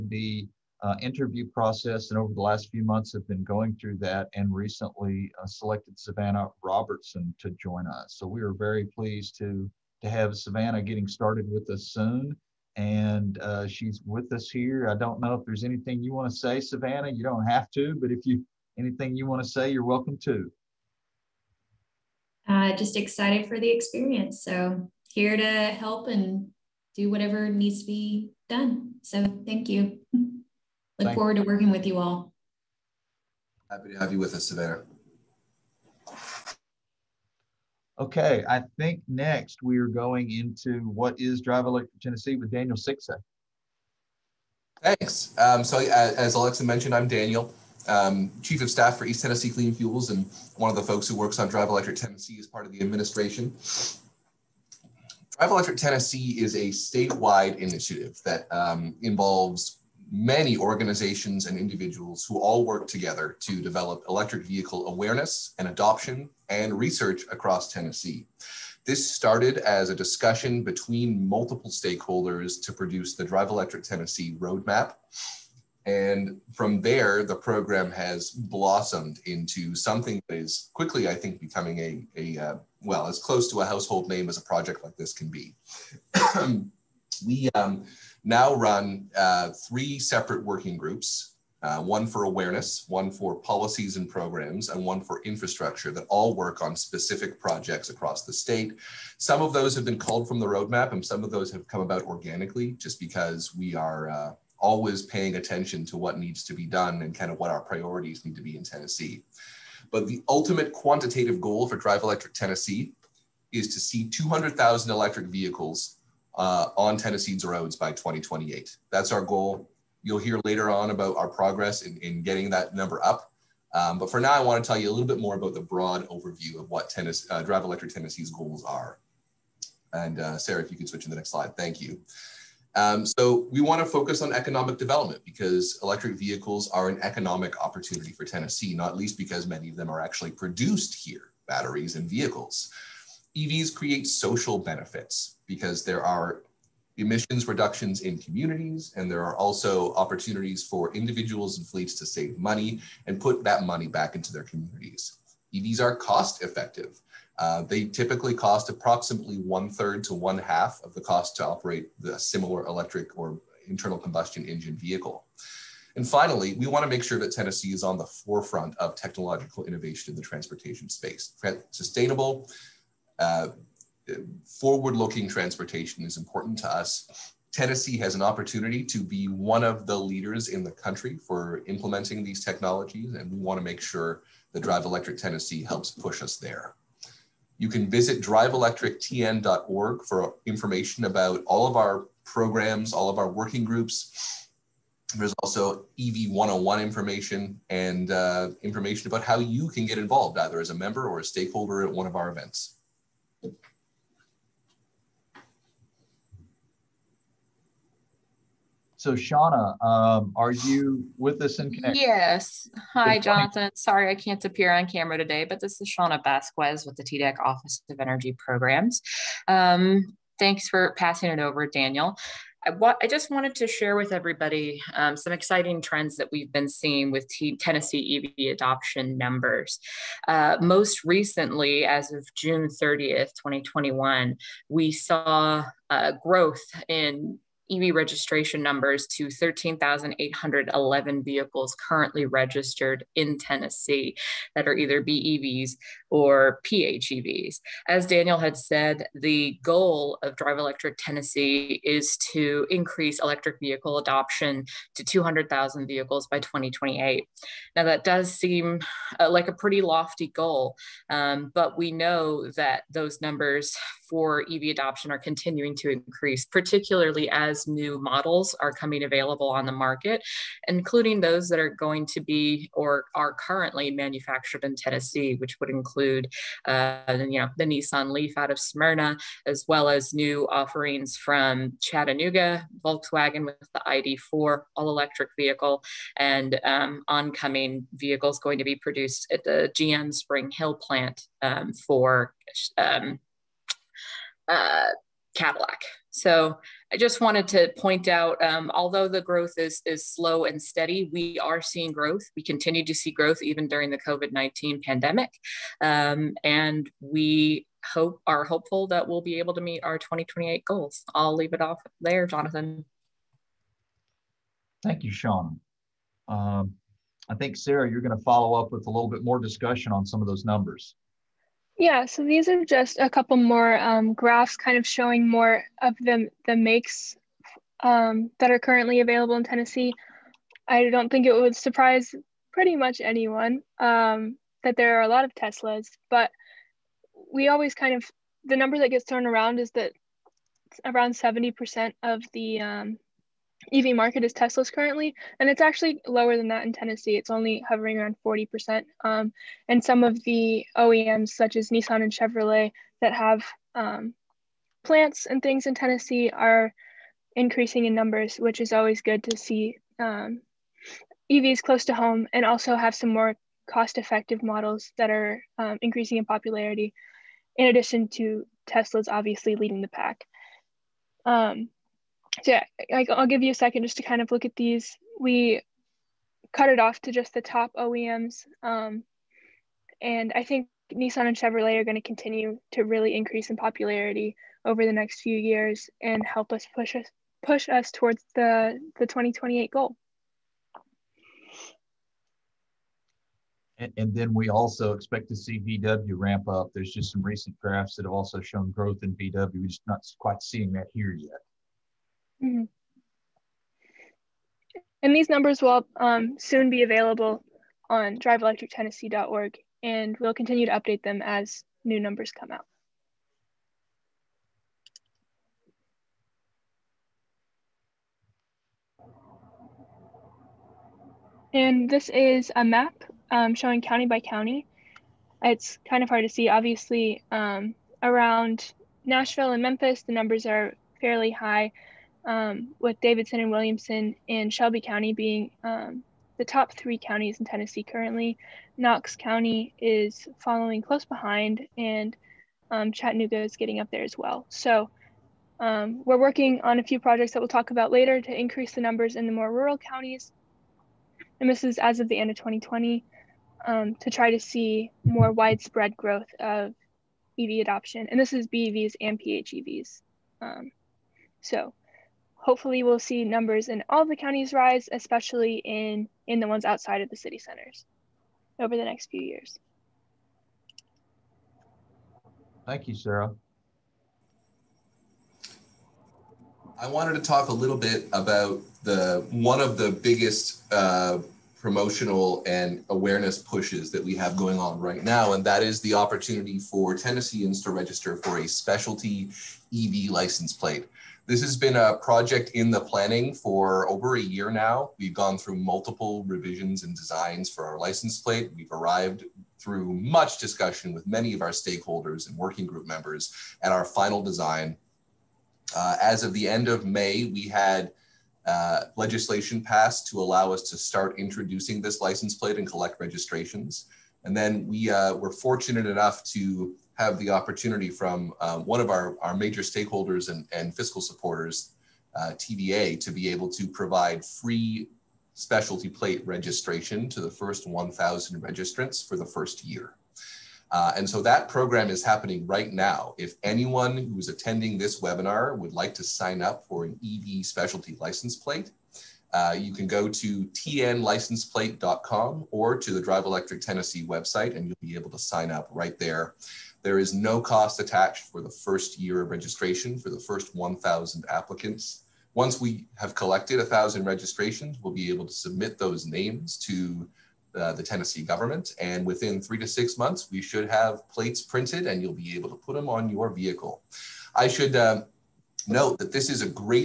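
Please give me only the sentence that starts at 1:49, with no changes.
But the ultimate quantitative goal for Drive Electric Tennessee is to see 200,000 electric vehicles uh, on Tennessee's roads by 2028.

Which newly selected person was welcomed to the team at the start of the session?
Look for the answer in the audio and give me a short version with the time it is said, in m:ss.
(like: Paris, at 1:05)
Savannah Robertson, at 0:05.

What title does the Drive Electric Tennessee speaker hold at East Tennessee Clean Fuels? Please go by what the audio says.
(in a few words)
chief of staff.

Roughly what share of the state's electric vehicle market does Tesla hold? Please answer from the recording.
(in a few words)
40%.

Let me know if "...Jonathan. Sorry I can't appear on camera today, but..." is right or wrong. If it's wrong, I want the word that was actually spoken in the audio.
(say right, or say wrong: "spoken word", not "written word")
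right.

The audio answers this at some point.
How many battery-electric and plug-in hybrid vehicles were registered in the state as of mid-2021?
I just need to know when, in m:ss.
3:59.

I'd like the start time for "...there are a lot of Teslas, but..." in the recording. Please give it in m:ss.
5:34.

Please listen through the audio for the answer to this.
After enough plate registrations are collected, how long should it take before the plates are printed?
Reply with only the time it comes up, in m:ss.
9:19.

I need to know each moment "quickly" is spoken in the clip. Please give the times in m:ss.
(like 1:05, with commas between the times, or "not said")
1:20.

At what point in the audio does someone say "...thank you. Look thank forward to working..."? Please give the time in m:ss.
0:29.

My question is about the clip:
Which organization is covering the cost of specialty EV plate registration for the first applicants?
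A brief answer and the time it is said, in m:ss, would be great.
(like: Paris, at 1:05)
TVA, at 8:42.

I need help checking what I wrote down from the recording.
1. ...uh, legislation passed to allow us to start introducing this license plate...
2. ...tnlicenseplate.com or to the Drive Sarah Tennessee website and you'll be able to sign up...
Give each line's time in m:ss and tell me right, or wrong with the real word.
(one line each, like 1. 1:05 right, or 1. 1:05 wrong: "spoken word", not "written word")
1. 8:28 right
2. 9:00 wrong: "Electric", not "Sarah".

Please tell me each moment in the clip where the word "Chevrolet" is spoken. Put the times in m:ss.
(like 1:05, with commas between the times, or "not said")
5:52, 6:21.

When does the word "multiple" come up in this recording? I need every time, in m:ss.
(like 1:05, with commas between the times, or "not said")
1:11, 8:15.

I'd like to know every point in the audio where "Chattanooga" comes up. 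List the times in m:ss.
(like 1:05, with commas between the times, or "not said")
4:41, 7:22.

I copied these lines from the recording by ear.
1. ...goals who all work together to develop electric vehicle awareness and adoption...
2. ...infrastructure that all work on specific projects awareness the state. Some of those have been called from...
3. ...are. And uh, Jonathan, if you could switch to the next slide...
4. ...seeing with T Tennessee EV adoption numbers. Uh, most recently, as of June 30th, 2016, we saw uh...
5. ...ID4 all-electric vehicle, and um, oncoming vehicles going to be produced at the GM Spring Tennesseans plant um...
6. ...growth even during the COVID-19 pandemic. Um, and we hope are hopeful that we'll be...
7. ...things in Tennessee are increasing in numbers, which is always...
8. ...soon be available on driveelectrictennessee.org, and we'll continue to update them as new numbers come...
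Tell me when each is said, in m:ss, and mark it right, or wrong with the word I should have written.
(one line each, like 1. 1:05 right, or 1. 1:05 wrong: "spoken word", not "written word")
1. 1:01 wrong: "individuals", not "goals"
2. 1:35 wrong: "across", not "awareness"
3. 2:08 wrong: "Sarah", not "Jonathan"
4. 3:46 wrong: "2021", not "2016"
5. 4:43 wrong: "Hill", not "Tennesseans"
6. 5:03 right
7. 5:55 right
8. 6:46 right.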